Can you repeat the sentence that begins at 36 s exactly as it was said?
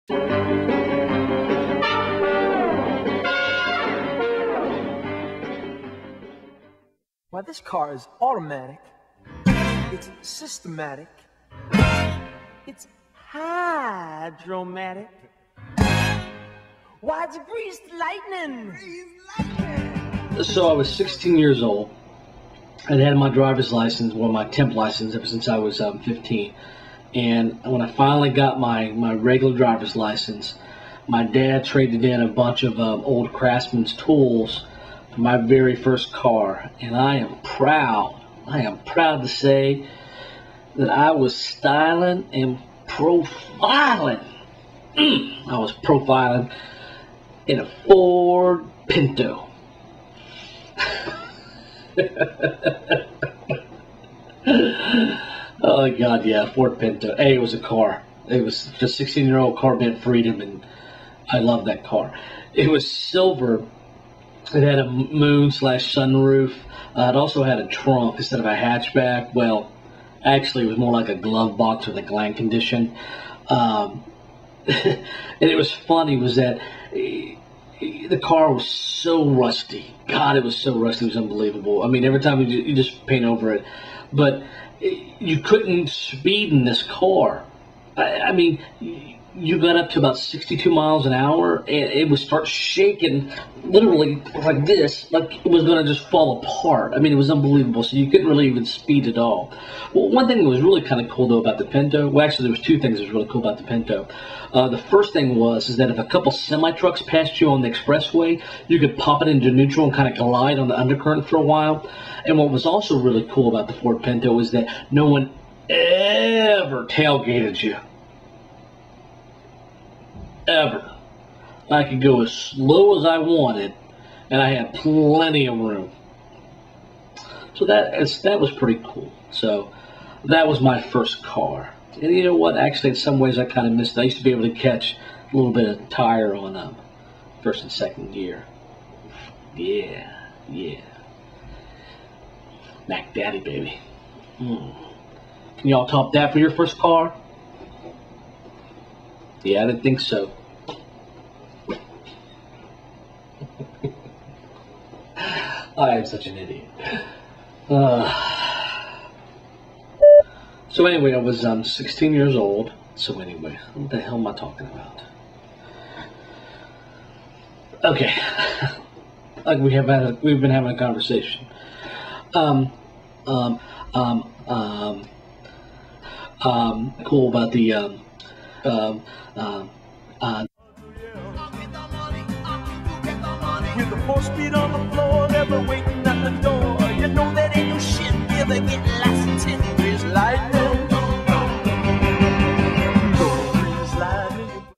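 And I am proud, I am proud to say that I was styling and profiling.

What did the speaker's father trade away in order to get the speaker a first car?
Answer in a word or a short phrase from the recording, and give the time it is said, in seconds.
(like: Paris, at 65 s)
Old Craftsman tools, at 33 s.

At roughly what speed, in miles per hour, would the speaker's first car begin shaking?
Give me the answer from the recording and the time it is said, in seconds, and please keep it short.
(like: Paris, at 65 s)
62, at 90 s.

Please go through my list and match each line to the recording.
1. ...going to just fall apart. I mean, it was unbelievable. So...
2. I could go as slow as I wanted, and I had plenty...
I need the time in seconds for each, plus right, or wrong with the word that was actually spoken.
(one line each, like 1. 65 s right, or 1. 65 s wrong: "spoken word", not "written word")
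1. 95 s right
2. 121 s right.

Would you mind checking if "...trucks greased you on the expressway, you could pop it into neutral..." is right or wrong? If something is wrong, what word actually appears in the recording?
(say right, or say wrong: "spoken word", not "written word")
wrong: "passed", not "greased".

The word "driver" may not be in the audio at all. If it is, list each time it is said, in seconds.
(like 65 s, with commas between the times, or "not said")
23 s, 29 s.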